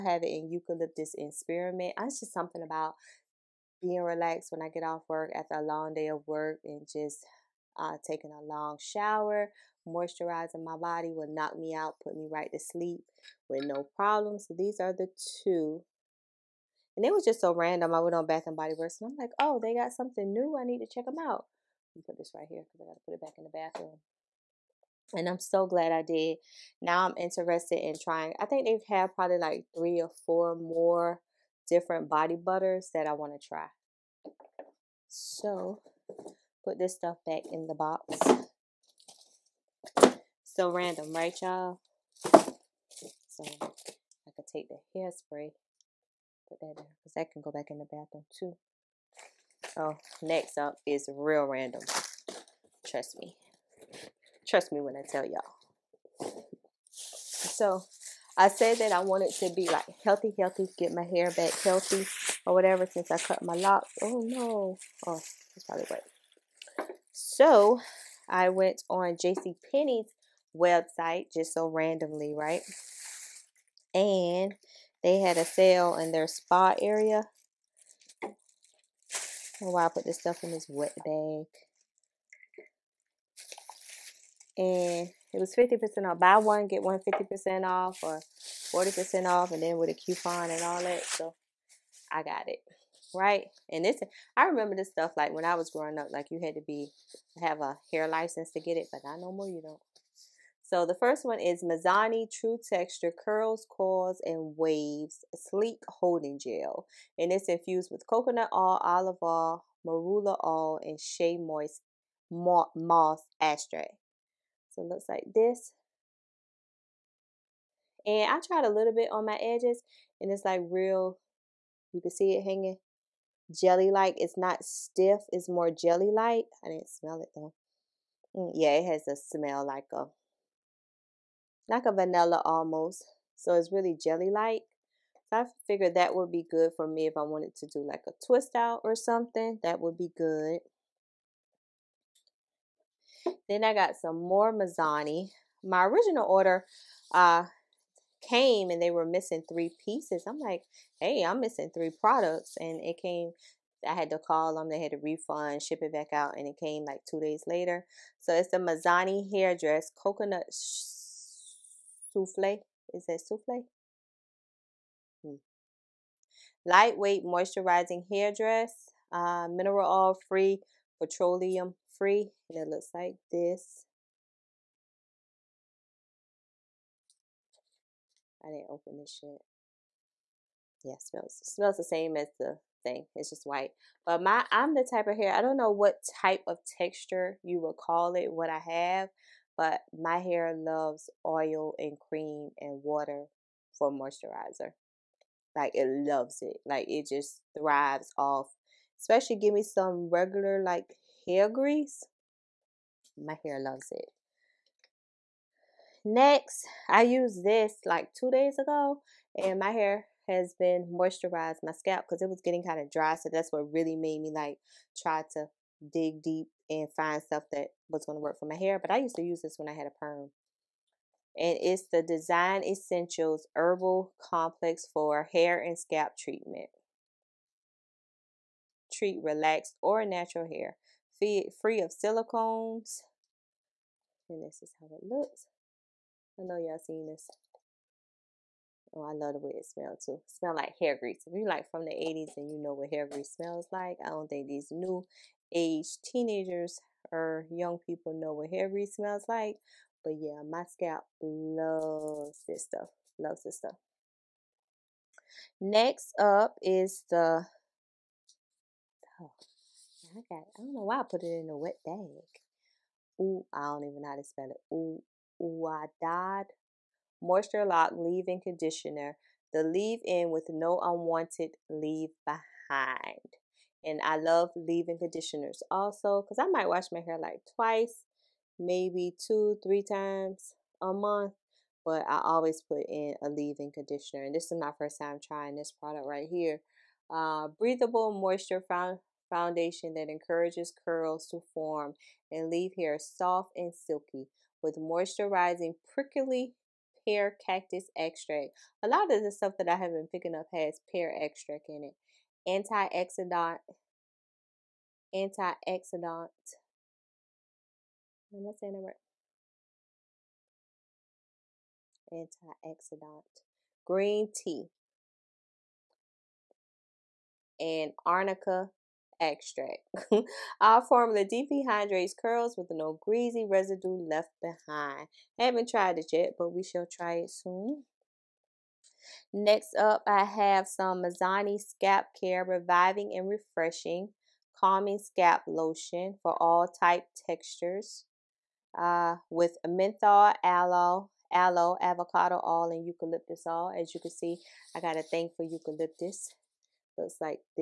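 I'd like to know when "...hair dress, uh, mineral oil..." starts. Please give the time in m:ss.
2:48.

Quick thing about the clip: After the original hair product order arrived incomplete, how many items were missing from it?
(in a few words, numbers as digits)
3.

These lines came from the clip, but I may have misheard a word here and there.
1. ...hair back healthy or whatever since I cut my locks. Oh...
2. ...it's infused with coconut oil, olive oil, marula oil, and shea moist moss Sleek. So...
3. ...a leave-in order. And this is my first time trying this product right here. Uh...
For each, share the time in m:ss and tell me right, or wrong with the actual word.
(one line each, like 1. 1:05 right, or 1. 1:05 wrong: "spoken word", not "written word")
1. 1:01 right
2. 1:47 wrong: "Extract", not "Sleek"
3. 4:43 wrong: "conditioner", not "order".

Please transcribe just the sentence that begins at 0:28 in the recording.
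I think they've had probably like three or four more different body butters that I want to try.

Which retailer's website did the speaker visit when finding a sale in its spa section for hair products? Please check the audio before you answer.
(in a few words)
JC Penney.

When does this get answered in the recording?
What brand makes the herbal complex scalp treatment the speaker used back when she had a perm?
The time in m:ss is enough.
3:42.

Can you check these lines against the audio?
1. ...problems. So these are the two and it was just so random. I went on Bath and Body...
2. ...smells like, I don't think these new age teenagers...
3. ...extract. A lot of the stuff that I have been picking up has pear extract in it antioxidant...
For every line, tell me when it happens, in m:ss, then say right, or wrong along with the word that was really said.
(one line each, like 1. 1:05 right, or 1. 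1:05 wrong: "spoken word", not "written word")
1. 0:13 right
2. 4:03 right
3. 4:57 right.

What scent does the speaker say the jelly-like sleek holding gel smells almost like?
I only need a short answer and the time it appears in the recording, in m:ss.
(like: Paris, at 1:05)
Vanilla, at 2:11.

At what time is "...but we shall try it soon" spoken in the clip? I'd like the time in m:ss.
5:26.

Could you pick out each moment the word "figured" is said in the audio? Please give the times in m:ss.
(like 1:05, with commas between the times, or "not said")
2:15.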